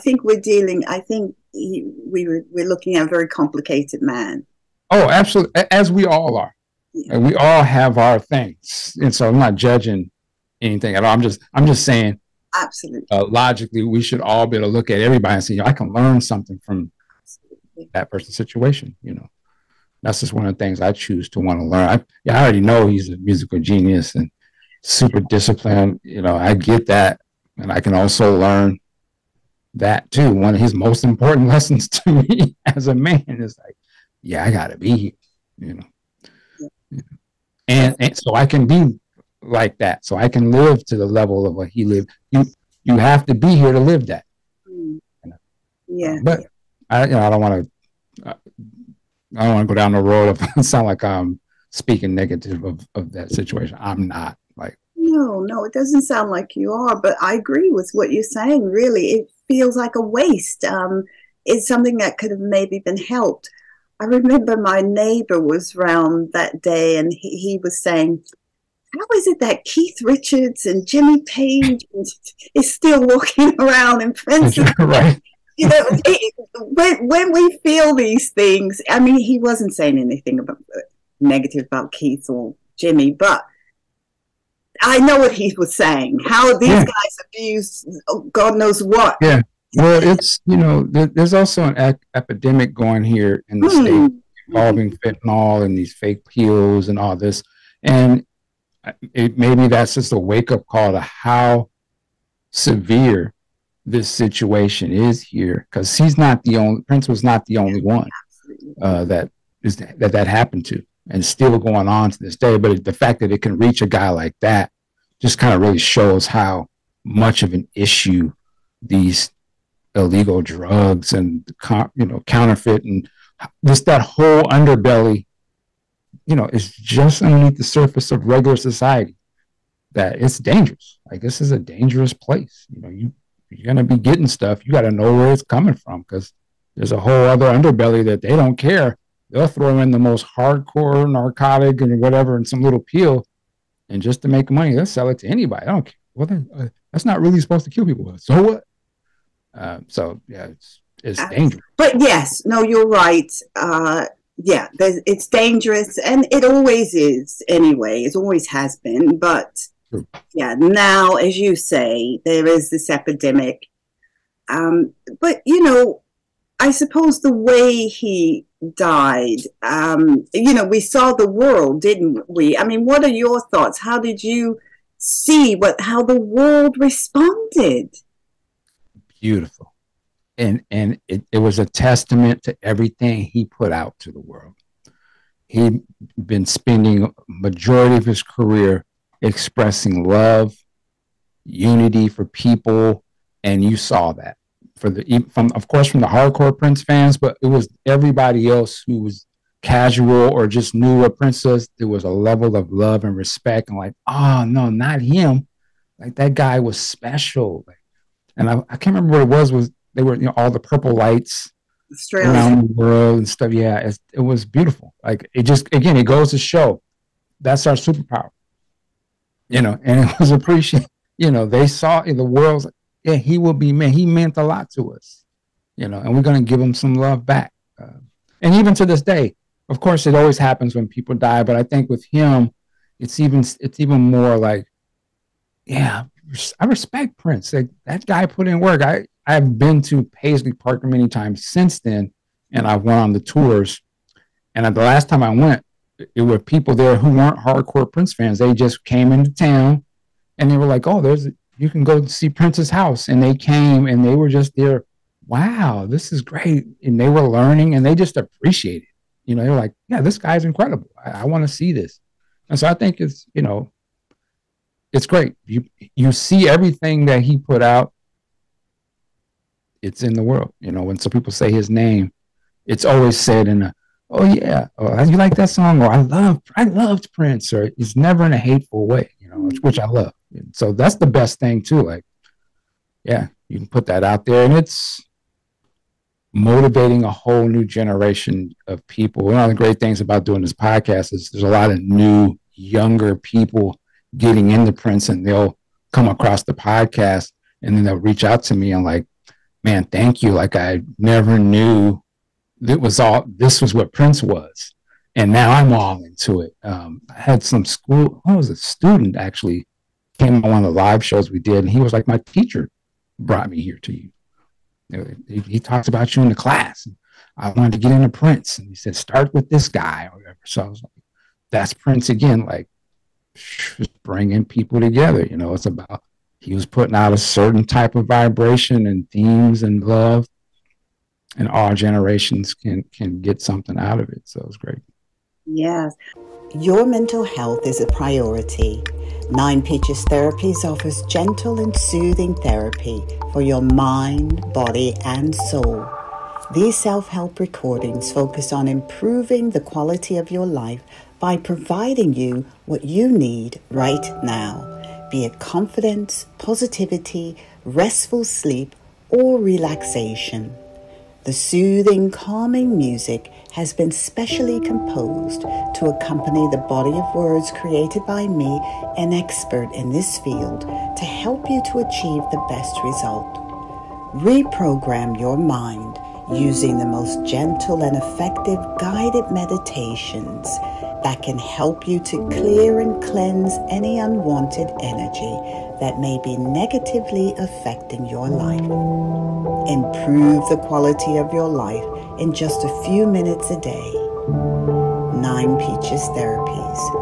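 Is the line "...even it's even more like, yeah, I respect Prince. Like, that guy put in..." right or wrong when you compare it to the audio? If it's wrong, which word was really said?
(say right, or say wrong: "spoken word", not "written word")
right.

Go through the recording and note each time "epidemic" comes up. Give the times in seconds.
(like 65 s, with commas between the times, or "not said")
92 s, 162 s.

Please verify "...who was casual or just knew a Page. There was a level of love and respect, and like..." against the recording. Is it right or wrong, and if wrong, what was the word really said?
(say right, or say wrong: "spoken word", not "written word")
wrong: "Princess", not "Page".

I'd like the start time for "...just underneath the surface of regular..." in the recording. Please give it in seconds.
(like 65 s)
126 s.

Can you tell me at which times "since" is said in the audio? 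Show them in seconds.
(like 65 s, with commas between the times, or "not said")
241 s.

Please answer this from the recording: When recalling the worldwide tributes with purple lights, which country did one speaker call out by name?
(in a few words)
Australia.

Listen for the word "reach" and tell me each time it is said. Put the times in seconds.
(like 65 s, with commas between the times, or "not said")
113 s, 297 s.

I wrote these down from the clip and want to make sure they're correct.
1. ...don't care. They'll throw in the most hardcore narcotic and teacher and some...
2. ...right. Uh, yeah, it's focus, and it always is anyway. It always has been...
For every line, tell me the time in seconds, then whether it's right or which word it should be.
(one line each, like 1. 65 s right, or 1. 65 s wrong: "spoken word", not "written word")
1. 138 s wrong: "whatever", not "teacher"
2. 152 s wrong: "dangerous", not "focus".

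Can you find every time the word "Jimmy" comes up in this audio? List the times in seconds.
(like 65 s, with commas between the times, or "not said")
70 s, 82 s.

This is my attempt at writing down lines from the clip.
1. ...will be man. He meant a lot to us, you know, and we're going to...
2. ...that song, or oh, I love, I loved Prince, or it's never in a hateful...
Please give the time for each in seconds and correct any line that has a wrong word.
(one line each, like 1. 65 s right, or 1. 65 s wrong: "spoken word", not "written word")
1. 223 s right
2. 275 s right.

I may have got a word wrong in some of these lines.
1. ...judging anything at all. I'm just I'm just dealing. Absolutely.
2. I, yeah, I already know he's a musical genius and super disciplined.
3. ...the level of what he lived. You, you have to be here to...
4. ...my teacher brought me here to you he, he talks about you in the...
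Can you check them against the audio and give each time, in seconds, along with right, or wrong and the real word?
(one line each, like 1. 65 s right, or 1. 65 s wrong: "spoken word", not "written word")
1. 9 s wrong: "saying", not "dealing"
2. 21 s right
3. 40 s right
4. 312 s right.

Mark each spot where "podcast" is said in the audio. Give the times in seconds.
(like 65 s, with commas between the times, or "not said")
290 s, 296 s.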